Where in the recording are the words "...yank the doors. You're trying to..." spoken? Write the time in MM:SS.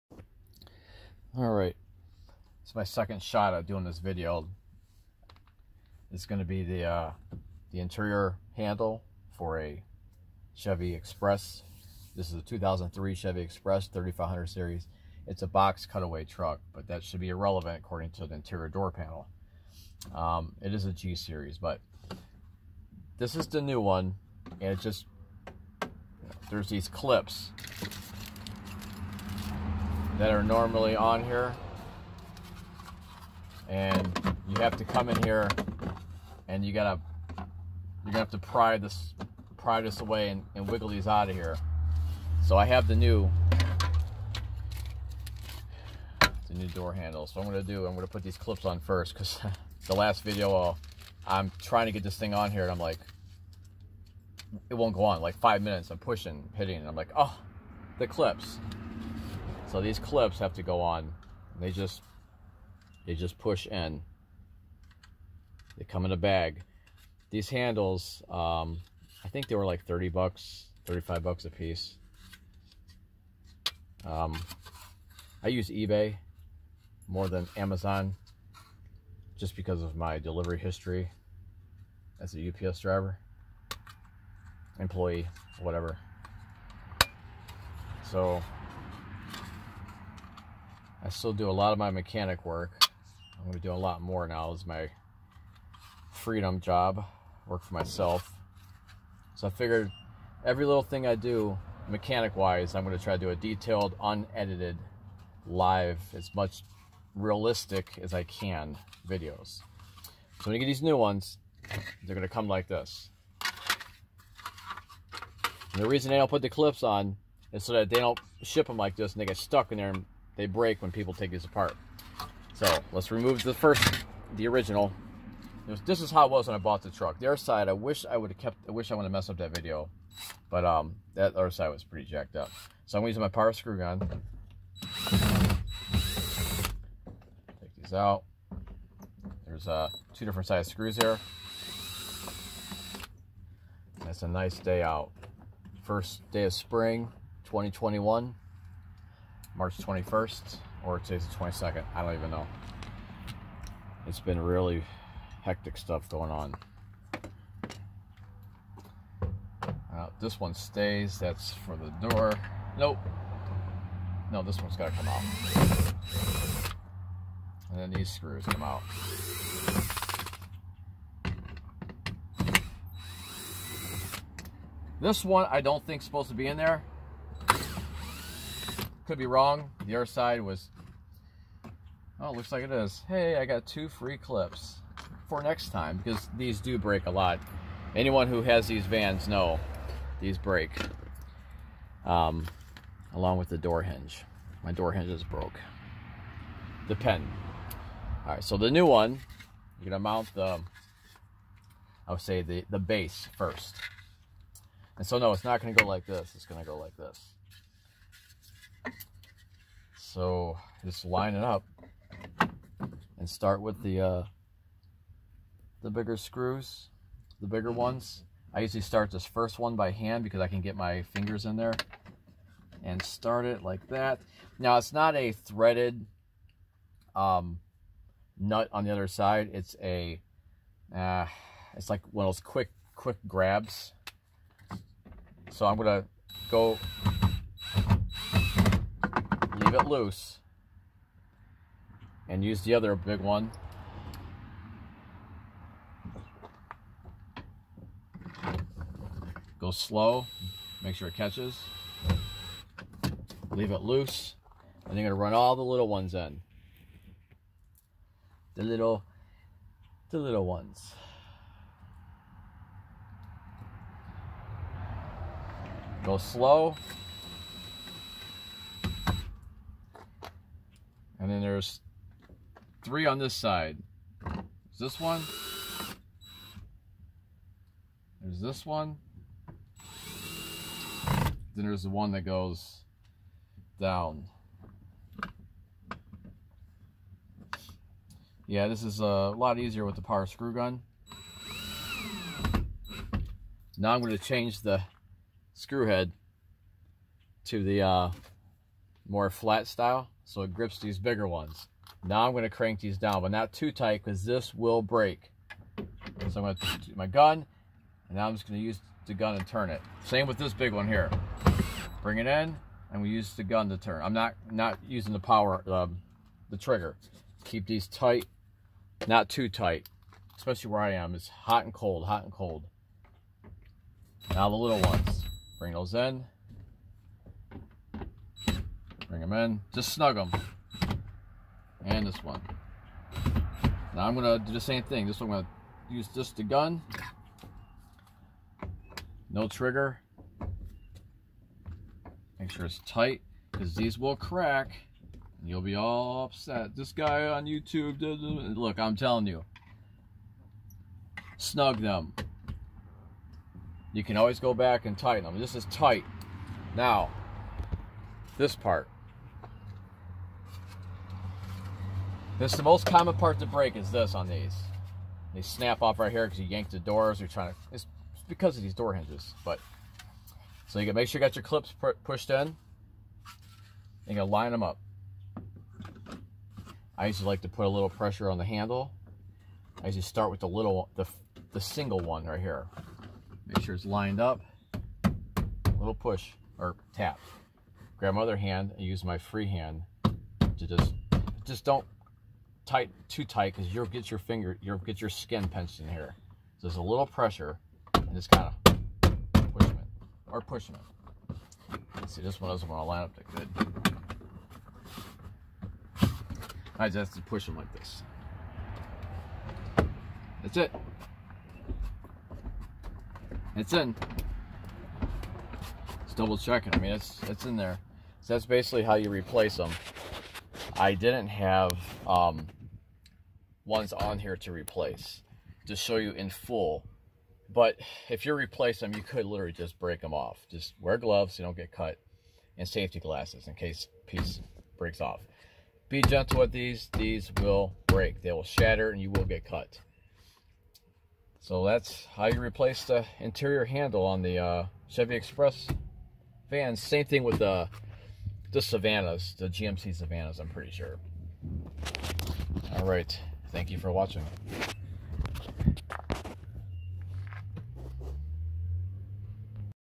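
06:06.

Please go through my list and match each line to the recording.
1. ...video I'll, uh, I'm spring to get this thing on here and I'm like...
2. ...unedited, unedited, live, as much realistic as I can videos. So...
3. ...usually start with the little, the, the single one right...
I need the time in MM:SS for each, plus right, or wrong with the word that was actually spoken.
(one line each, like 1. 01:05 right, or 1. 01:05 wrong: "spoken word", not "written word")
1. 00:50 wrong: "trying", not "spring"
2. 01:43 wrong: "detailed", not "unedited"
3. 06:19 right.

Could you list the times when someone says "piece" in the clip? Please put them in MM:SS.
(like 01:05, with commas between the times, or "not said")
01:11, 07:14.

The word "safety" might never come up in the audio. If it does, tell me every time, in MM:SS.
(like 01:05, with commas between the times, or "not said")
07:12.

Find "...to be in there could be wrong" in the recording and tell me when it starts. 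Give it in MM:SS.
02:56.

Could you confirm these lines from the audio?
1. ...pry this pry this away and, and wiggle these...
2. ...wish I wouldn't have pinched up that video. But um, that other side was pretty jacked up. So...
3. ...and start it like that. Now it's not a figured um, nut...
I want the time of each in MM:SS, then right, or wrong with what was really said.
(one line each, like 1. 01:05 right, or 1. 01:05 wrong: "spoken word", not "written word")
1. 00:38 right
2. 02:08 wrong: "messed", not "pinched"
3. 03:42 wrong: "threaded", not "figured".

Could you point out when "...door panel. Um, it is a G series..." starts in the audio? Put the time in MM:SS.
00:18.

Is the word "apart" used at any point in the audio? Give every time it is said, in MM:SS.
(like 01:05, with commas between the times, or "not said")
02:01.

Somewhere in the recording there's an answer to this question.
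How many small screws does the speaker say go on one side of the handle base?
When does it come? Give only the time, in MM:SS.
04:32.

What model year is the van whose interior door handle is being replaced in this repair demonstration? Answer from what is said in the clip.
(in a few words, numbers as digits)
2003.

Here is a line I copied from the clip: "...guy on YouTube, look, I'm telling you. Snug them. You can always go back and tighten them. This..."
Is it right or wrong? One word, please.
right.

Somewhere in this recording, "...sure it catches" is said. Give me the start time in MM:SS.
04:10.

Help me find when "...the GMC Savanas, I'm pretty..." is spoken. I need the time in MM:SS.
07:29.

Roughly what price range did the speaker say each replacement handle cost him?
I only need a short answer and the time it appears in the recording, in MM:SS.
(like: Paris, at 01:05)
30 to 35 dollars, at 01:09.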